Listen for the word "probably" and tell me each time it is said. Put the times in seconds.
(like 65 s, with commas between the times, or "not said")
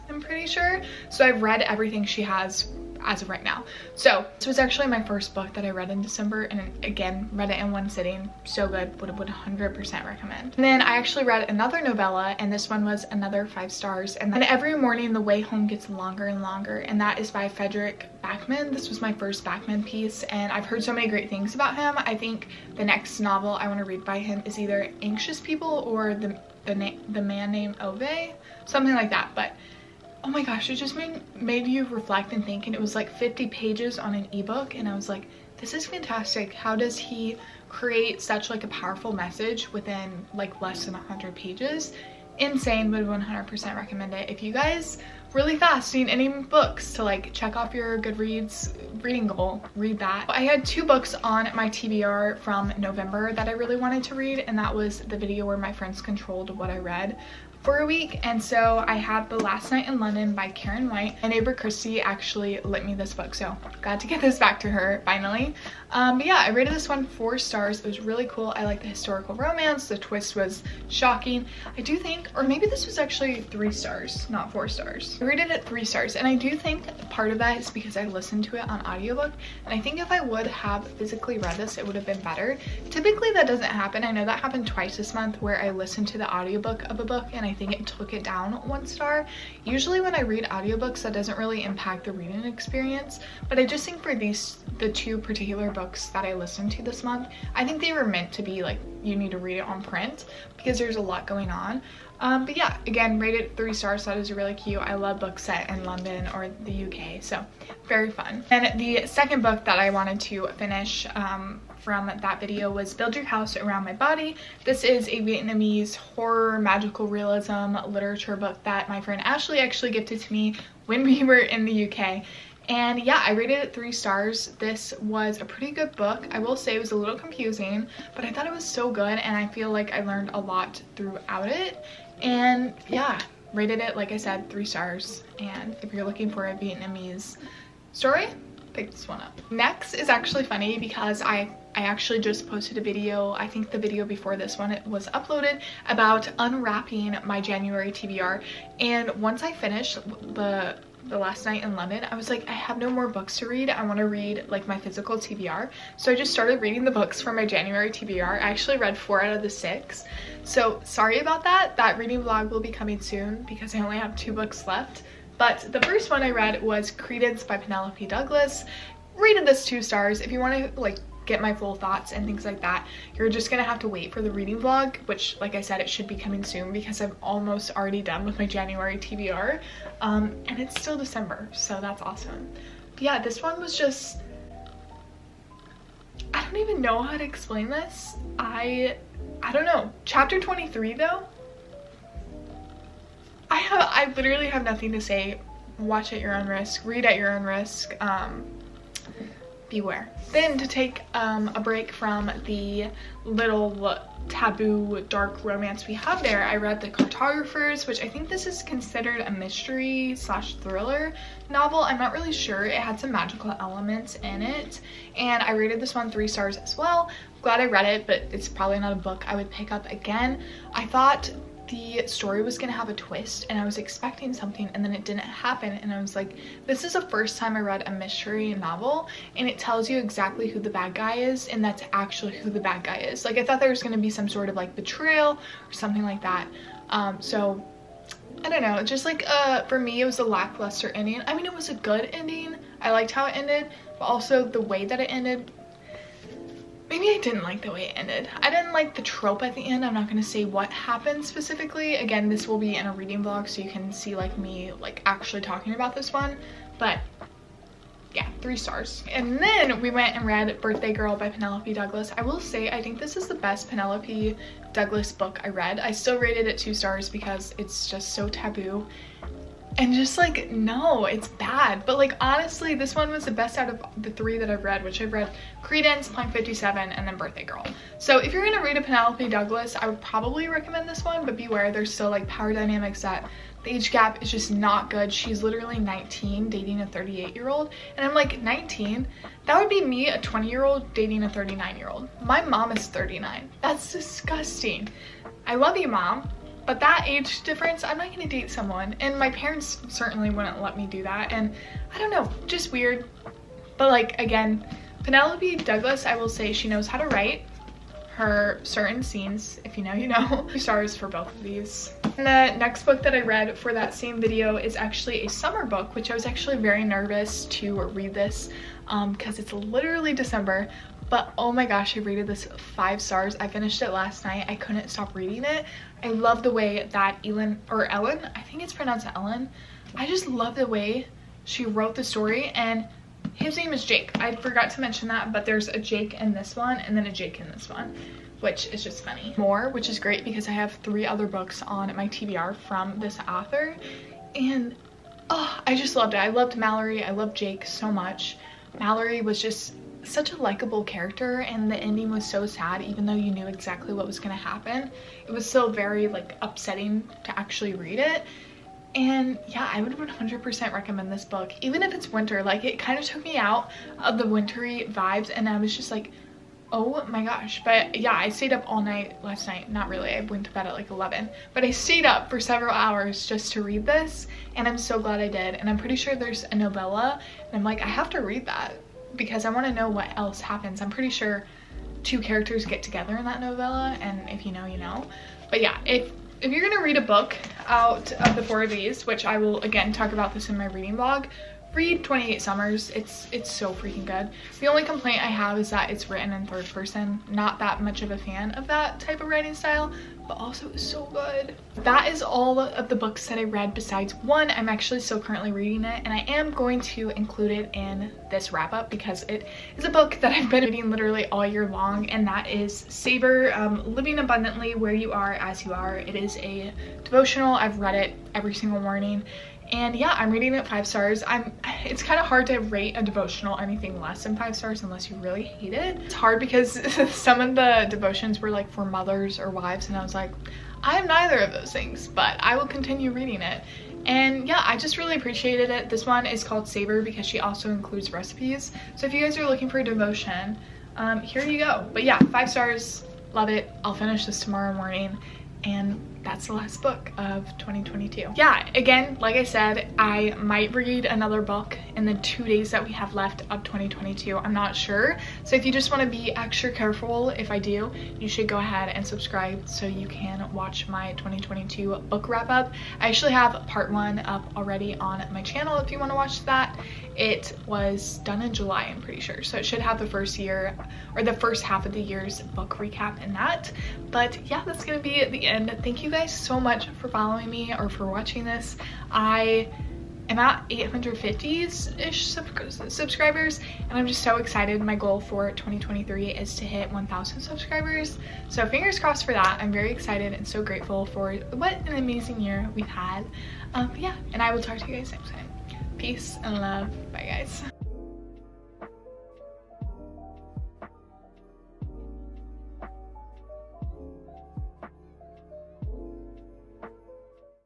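218 s, 280 s.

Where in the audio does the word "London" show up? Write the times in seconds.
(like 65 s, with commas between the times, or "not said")
59 s, 105 s, 151 s.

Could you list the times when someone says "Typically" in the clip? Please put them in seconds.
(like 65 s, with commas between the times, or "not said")
82 s.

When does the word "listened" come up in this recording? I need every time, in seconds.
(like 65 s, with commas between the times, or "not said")
78 s, 85 s, 96 s.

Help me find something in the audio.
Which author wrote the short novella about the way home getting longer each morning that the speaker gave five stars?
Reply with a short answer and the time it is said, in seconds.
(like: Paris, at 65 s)
Fredrik Backman, at 17 s.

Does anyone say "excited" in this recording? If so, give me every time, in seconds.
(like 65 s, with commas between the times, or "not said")
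484 s, 489 s.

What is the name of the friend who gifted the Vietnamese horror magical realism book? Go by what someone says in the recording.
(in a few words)
Ashley.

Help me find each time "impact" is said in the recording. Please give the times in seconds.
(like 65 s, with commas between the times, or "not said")
91 s.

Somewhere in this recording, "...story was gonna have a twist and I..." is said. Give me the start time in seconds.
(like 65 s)
222 s.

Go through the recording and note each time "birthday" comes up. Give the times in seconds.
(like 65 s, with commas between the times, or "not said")
260 s, 277 s.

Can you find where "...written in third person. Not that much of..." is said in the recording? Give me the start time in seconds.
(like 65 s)
396 s.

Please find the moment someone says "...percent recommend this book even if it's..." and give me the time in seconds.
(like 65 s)
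360 s.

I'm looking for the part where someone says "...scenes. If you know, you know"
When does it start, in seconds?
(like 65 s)
309 s.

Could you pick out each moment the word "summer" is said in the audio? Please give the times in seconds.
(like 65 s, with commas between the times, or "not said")
315 s, 392 s.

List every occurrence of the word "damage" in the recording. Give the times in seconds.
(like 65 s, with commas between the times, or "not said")
not said.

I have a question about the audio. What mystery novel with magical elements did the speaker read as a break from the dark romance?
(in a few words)
The Cartographers.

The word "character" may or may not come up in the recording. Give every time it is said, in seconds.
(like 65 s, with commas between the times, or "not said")
350 s, 382 s.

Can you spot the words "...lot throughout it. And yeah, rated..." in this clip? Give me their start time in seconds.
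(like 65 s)
130 s.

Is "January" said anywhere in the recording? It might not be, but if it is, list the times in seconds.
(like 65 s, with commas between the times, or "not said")
147 s, 157 s, 178 s.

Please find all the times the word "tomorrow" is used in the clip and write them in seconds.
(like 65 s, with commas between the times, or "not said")
444 s.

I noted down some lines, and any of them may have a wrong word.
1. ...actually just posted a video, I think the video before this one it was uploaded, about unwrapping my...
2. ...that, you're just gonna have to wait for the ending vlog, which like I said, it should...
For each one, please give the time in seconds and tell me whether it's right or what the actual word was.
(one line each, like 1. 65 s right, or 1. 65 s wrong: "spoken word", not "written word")
1. 141 s right
2. 172 s wrong: "reading", not "ending".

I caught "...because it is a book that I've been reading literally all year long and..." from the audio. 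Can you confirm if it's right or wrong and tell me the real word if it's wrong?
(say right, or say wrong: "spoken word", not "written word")
right.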